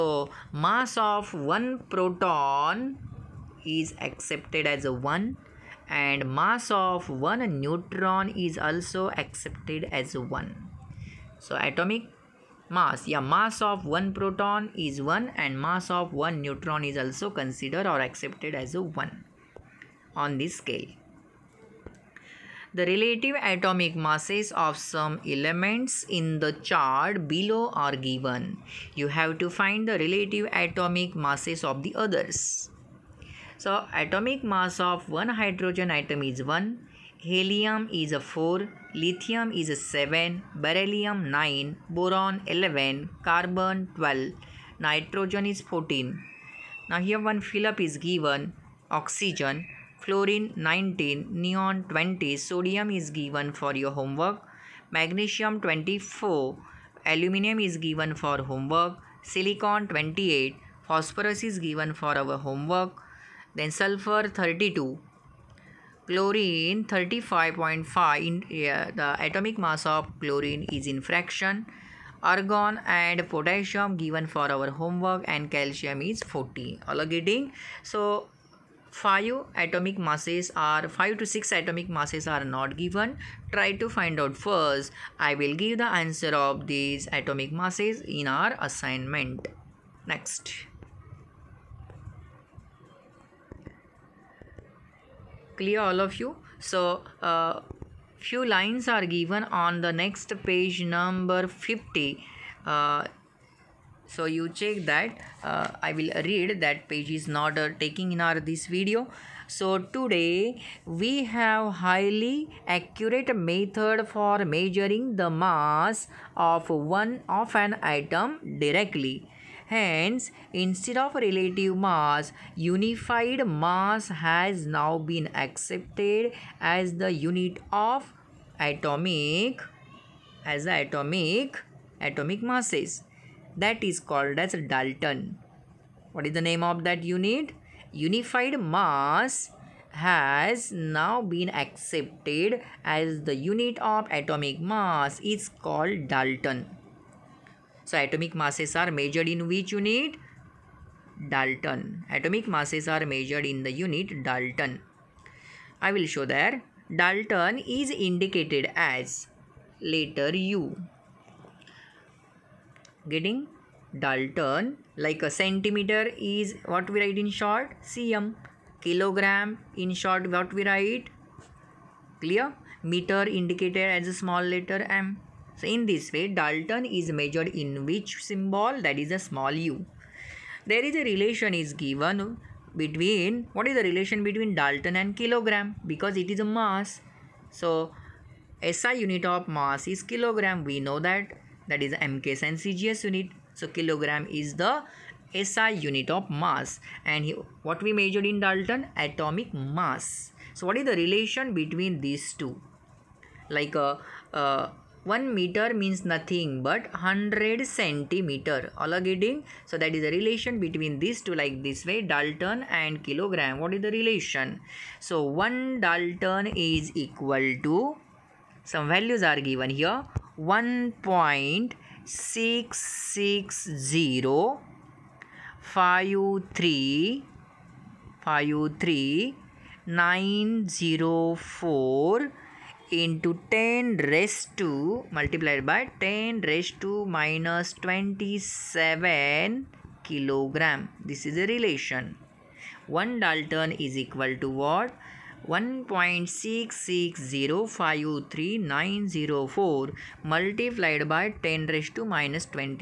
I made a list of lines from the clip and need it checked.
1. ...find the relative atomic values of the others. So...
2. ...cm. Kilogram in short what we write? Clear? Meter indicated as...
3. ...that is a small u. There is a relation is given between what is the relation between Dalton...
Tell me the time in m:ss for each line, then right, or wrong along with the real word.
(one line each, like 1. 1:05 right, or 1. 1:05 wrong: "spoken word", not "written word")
1. 0:29 wrong: "masses", not "values"
2. 2:47 right
3. 2:58 right.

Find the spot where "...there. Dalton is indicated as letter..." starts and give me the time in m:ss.
2:36.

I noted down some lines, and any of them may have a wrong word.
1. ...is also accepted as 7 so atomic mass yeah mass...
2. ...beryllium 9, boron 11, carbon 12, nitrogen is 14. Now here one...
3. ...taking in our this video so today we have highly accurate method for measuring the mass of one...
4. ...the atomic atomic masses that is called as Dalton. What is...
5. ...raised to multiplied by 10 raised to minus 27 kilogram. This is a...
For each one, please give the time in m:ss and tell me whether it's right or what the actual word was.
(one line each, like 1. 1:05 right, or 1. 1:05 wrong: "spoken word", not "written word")
1. 0:08 wrong: "1", not "7"
2. 0:40 right
3. 1:47 right
4. 2:10 right
5. 3:54 right.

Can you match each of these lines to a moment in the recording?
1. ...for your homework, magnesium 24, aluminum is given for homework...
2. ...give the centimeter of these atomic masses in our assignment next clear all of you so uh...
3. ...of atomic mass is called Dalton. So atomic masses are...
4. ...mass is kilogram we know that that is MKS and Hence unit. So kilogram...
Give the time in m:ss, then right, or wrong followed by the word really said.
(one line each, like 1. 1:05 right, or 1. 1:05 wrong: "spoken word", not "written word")
1. 0:53 right
2. 1:25 wrong: "answer", not "centimeter"
3. 2:23 right
4. 3:09 wrong: "CGS", not "Hence".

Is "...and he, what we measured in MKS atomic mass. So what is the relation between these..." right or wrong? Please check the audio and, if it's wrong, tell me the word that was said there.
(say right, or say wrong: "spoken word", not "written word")
wrong: "Dalton", not "MKS".